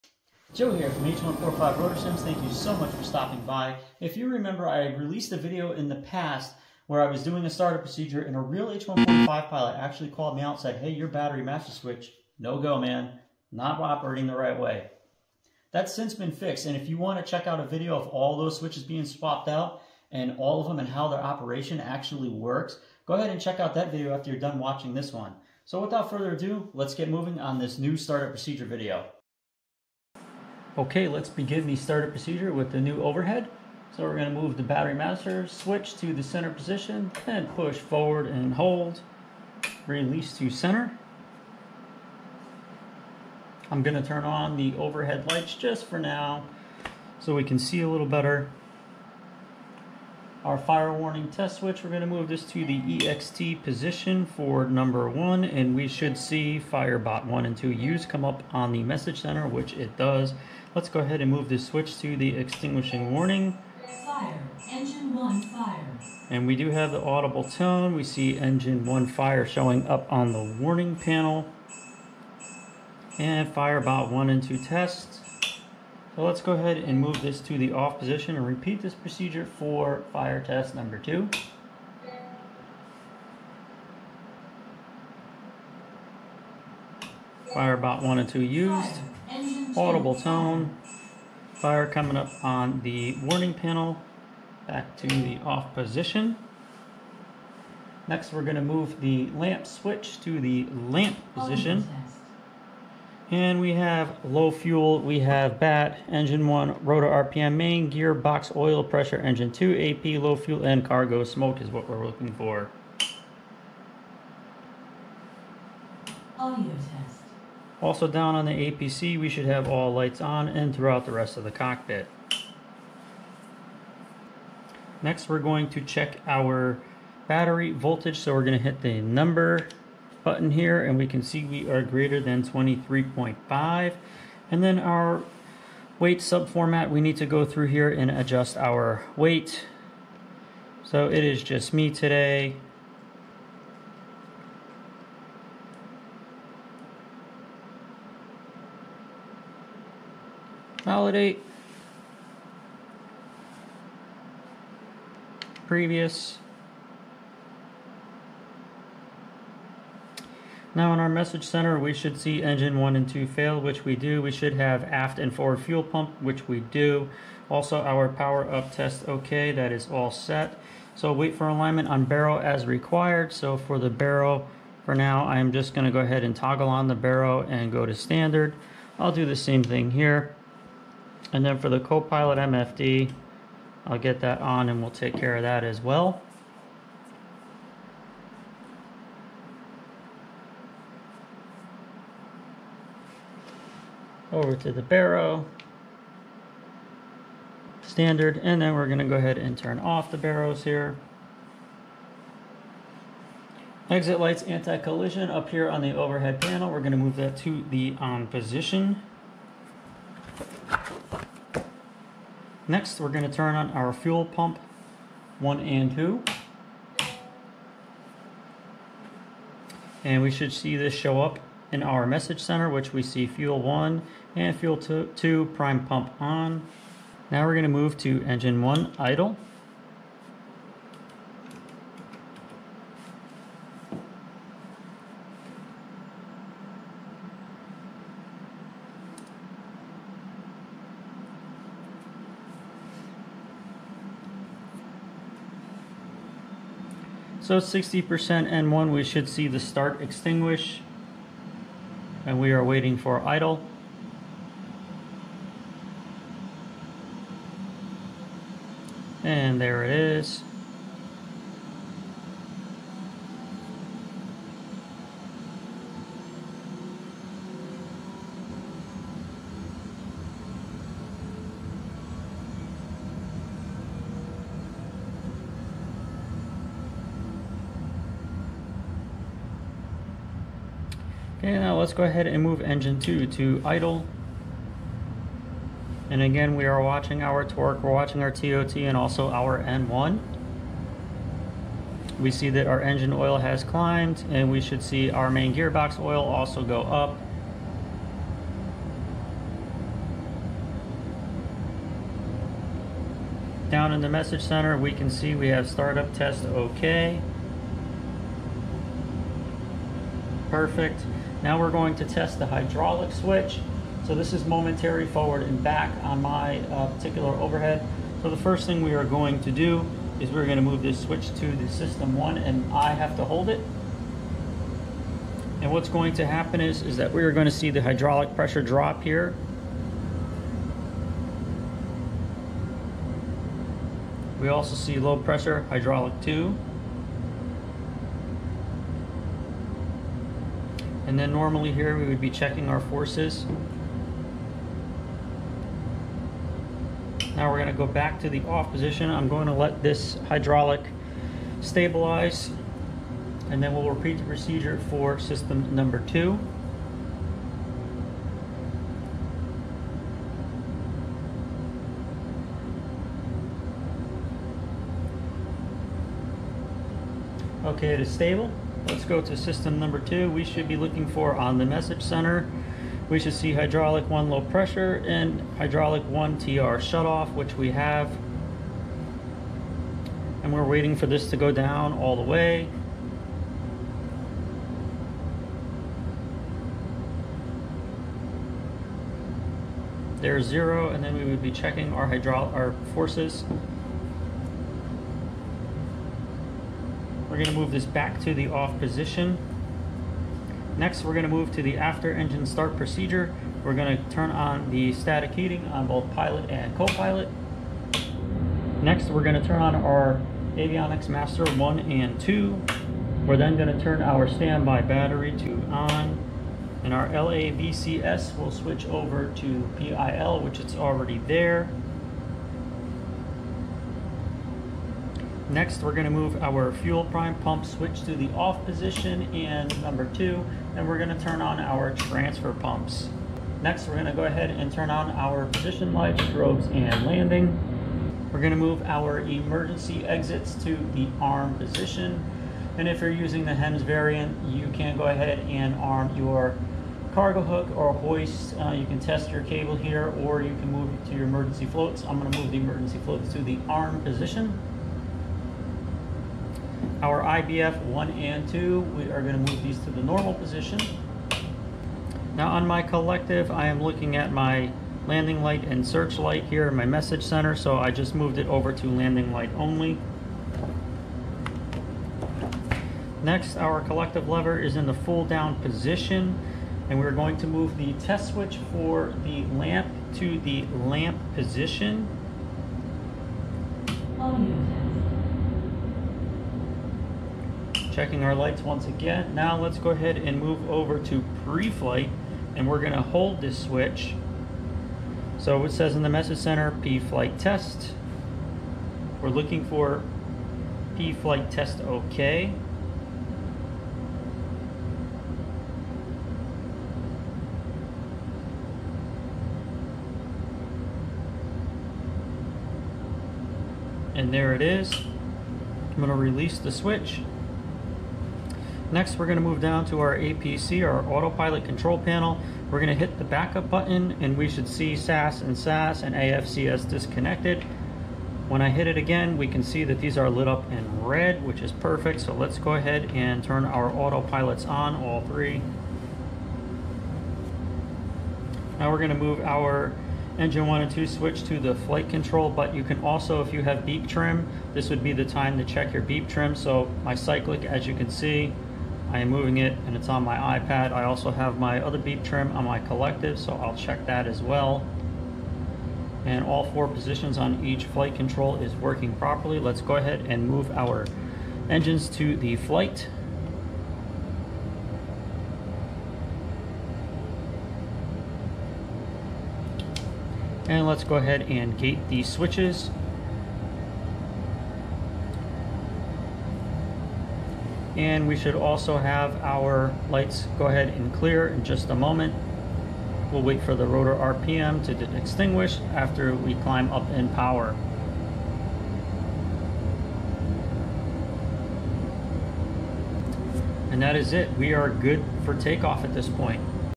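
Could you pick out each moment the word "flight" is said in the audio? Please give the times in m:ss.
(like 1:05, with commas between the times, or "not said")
8:11, 8:16, 8:20, 9:01, 9:17, 9:22.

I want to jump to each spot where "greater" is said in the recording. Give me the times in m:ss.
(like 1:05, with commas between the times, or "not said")
2:11.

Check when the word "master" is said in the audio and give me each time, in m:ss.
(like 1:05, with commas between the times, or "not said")
0:11, 0:34, 6:51.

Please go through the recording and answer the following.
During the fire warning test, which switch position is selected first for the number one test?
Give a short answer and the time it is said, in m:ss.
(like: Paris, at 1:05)
EXT, at 0:52.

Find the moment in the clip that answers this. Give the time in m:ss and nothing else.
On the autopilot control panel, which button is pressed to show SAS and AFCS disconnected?
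8:43.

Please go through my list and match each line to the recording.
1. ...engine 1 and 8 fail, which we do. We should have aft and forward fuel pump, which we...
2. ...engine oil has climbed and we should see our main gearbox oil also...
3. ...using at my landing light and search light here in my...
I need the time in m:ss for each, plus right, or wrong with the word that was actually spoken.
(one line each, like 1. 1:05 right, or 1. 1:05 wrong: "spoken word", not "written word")
1. 2:42 wrong: "2", not "8"
2. 4:52 right
3. 7:43 wrong: "looking", not "using".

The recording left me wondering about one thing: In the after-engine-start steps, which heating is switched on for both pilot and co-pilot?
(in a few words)
Static heating.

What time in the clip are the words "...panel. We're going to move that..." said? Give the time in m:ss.
3:26.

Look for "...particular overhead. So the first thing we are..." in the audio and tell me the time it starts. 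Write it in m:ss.
5:16.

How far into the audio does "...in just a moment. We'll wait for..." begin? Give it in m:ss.
9:41.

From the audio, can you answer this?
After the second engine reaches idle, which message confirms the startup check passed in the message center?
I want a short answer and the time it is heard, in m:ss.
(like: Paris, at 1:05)
Startup test okay, at 5:05.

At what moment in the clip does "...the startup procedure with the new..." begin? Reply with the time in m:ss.
0:31.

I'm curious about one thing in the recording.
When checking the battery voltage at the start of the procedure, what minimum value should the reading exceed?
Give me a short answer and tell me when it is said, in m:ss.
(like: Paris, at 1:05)
23.5, at 2:12.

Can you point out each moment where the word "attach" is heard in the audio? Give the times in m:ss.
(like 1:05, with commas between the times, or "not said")
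not said.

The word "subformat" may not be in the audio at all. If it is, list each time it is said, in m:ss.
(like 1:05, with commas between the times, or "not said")
2:16.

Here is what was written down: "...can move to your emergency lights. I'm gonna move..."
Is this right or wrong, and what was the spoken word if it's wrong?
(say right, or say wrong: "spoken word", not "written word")
wrong: "floats", not "lights".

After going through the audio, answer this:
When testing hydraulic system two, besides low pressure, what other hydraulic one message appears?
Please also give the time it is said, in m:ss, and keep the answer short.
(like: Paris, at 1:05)
TR shutoff, at 6:16.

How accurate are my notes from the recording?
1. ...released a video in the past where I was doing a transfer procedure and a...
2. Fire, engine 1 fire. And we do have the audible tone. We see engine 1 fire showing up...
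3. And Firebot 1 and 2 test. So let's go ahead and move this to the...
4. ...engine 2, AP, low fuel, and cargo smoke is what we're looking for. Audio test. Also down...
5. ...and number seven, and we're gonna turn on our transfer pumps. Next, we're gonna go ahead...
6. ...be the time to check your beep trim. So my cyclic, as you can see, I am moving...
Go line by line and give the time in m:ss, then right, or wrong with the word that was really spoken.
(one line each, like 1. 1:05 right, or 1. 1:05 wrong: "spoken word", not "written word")
1. 0:04 wrong: "starter", not "transfer"
2. 1:04 right
3. 1:13 right
4. 1:49 right
5. 7:09 wrong: "two", not "seven"
6. 9:05 right.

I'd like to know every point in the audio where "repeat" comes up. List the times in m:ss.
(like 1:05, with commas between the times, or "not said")
1:18, 5:53.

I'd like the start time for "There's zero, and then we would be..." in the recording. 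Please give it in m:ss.
6:30.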